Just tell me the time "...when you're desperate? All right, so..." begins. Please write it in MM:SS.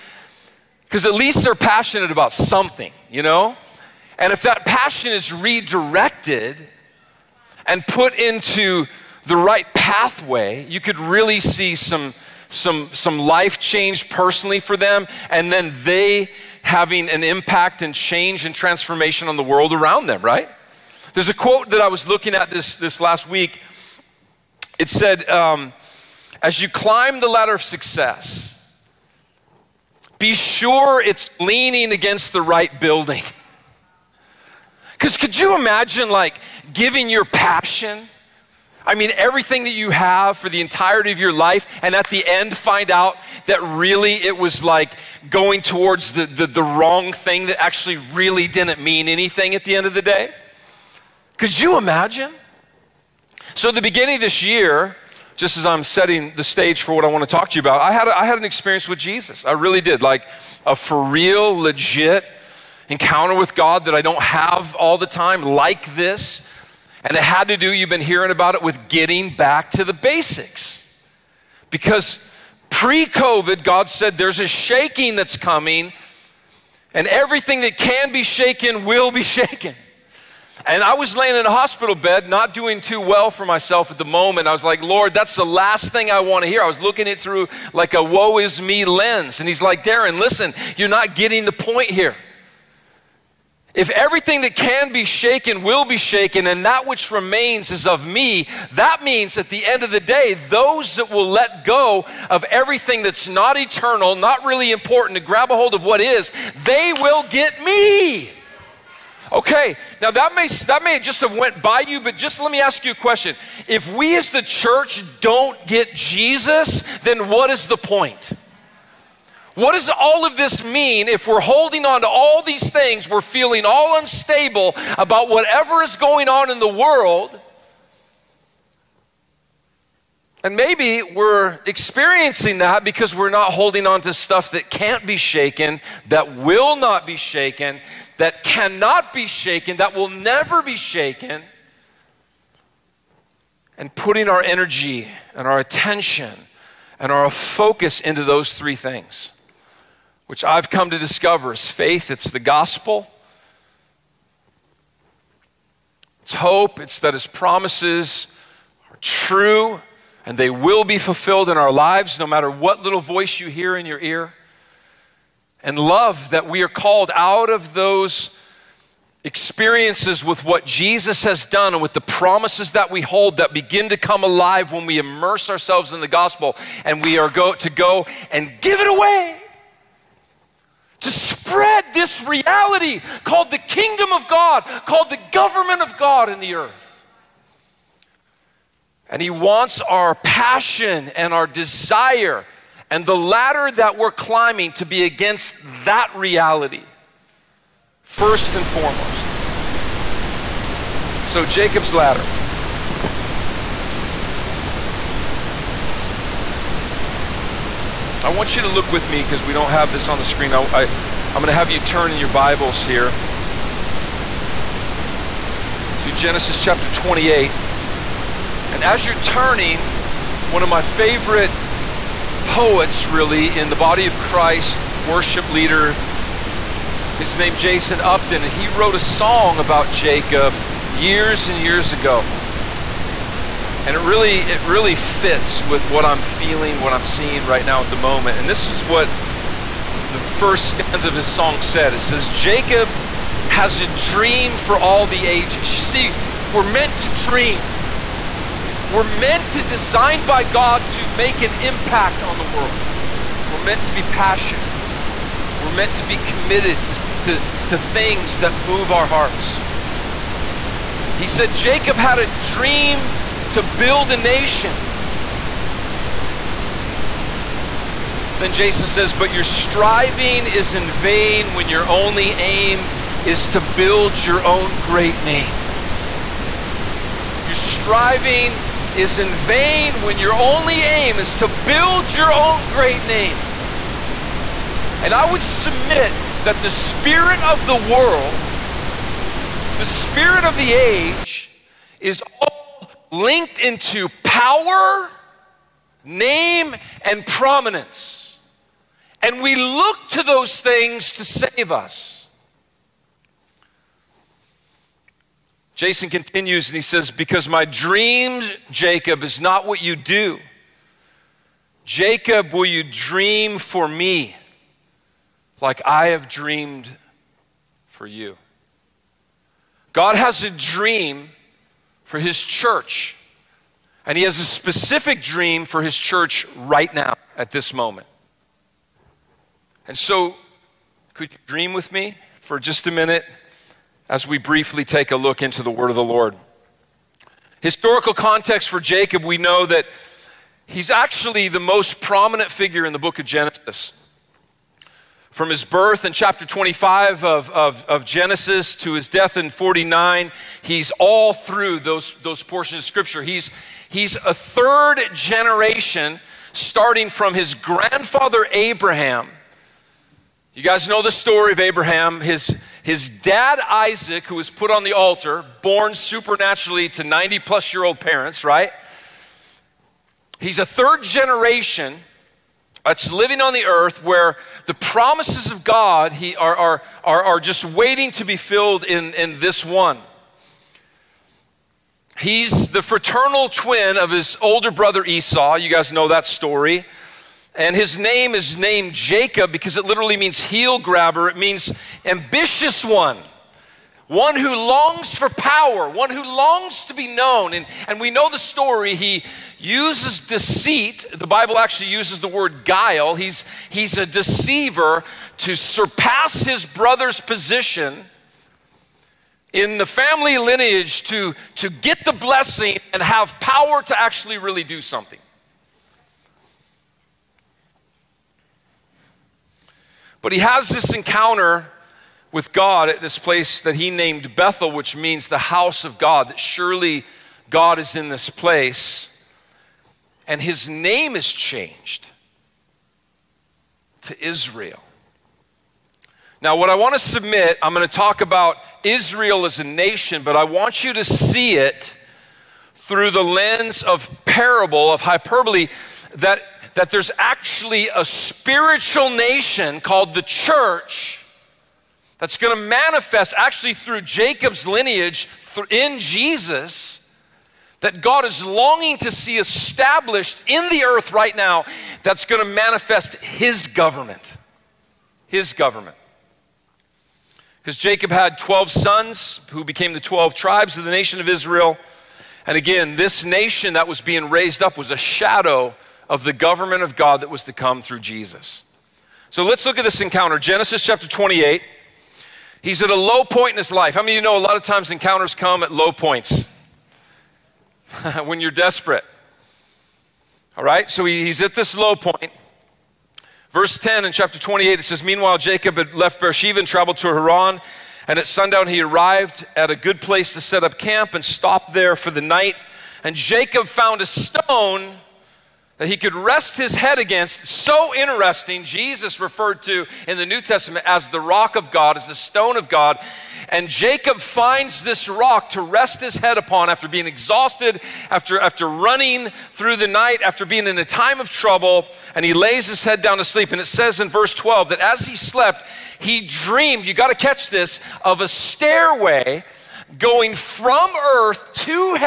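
08:08.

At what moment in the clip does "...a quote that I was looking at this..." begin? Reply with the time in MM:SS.
00:21.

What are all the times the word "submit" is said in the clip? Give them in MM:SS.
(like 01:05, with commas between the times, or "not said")
04:45, 07:16.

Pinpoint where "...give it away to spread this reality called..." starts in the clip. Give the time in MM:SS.
02:58.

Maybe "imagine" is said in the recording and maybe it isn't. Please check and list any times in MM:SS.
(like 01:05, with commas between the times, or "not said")
00:35, 00:51.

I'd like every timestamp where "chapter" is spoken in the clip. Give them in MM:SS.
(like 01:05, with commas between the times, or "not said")
03:36, 05:46, 08:00, 08:14.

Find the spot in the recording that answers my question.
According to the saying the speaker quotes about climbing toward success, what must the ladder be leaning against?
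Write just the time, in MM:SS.
00:32.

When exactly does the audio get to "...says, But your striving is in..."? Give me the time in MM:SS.
04:28.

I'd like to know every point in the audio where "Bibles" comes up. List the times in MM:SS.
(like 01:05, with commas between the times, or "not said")
03:32, 06:41.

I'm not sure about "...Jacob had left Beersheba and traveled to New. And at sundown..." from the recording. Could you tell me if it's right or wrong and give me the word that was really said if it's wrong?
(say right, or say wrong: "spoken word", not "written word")
wrong: "Haran", not "New".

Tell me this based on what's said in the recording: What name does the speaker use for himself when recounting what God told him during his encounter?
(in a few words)
Darren.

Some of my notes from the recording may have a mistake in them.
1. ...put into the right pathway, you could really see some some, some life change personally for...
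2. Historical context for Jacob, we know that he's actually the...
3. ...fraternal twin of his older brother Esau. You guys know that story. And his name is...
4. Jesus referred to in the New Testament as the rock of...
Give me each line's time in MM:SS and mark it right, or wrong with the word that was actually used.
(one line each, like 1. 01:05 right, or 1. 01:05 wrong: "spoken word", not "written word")
1. 00:07 right
2. 05:37 right
3. 06:22 right
4. 08:28 right.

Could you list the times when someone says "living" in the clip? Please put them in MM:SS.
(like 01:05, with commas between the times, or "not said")
06:13.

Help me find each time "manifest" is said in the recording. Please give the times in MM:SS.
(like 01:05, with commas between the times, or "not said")
07:32, 07:42.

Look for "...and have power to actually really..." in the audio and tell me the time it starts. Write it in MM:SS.
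06:52.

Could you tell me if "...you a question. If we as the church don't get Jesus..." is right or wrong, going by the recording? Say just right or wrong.
right.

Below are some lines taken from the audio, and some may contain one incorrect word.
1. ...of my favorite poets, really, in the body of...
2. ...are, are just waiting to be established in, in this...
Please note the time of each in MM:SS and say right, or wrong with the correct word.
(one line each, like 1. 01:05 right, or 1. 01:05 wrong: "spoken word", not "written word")
1. 03:40 right
2. 06:17 wrong: "filled", not "established".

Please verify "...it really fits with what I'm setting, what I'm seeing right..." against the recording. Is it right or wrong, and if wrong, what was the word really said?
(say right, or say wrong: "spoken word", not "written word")
wrong: "feeling", not "setting".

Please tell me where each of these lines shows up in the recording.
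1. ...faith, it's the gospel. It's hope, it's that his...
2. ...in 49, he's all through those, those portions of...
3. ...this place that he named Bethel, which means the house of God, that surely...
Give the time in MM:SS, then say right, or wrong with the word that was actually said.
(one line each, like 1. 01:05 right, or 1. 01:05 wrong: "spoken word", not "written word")
1. 02:31 right
2. 05:49 right
3. 07:02 right.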